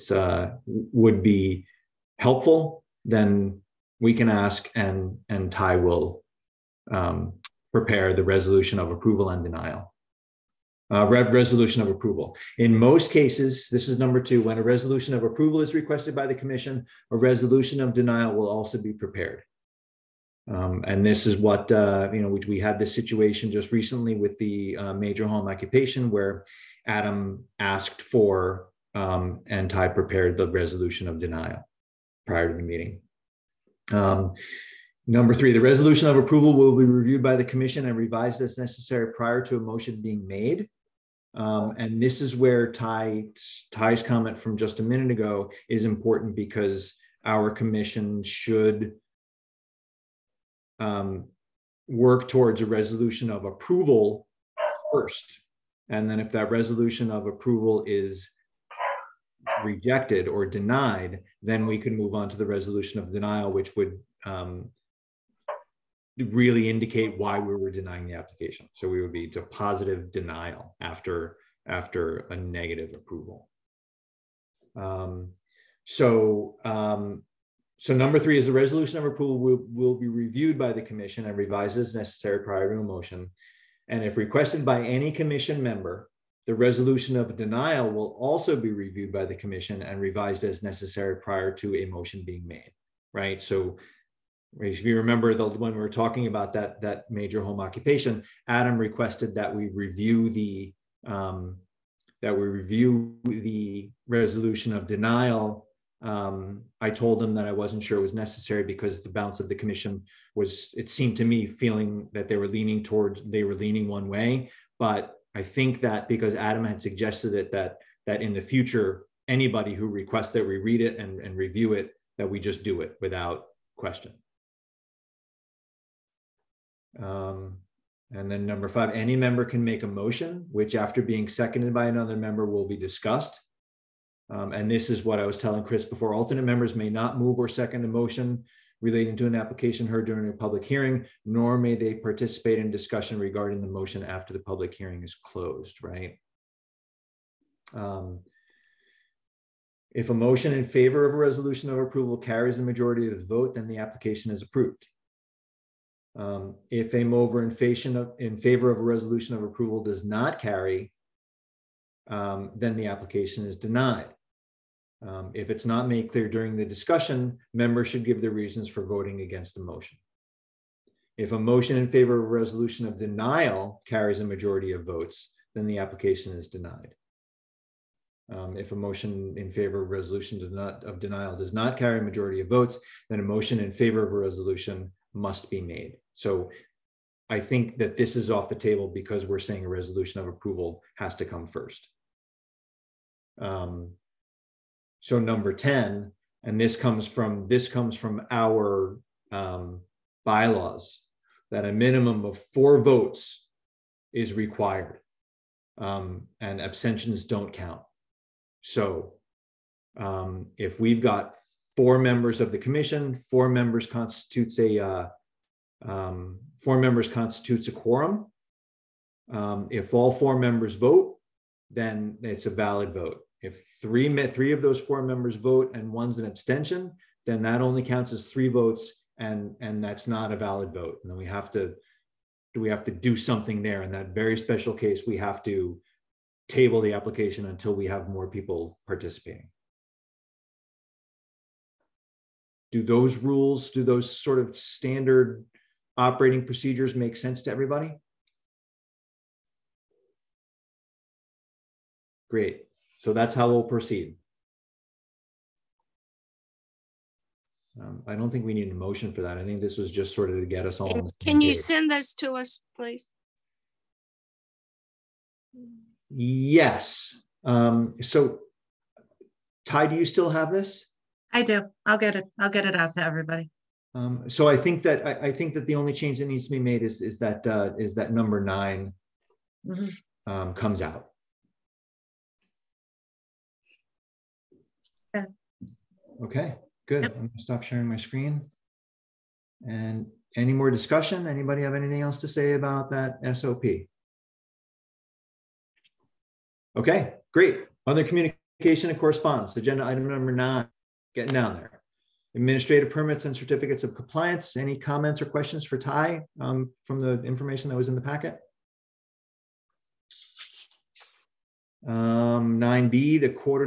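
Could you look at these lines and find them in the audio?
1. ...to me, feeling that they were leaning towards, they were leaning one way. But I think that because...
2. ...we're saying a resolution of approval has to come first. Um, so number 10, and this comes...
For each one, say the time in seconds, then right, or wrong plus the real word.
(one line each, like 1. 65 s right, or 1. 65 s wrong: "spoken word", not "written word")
1. 111 s right
2. 189 s right.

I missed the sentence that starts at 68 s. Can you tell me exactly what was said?
So we would be to positive denial after after a negative approval.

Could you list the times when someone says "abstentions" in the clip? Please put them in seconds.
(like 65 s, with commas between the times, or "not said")
206 s, 226 s.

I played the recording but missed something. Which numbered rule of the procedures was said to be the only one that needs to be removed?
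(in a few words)
9.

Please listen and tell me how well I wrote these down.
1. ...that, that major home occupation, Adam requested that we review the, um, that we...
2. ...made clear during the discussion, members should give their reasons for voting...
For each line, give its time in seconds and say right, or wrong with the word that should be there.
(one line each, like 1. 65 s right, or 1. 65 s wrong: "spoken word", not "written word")
1. 96 s right
2. 165 s right.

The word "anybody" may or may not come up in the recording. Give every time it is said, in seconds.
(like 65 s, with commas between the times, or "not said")
119 s, 291 s.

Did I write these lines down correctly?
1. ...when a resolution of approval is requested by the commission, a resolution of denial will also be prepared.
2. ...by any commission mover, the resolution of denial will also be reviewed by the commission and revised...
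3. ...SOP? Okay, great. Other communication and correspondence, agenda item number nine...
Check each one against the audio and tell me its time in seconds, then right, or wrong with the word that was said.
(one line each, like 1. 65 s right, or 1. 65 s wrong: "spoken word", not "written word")
1. 14 s right
2. 84 s wrong: "member", not "mover"
3. 293 s right.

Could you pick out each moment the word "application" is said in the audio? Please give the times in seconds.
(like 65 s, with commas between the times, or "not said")
68 s, 139 s, 153 s, 162 s, 175 s, 236 s.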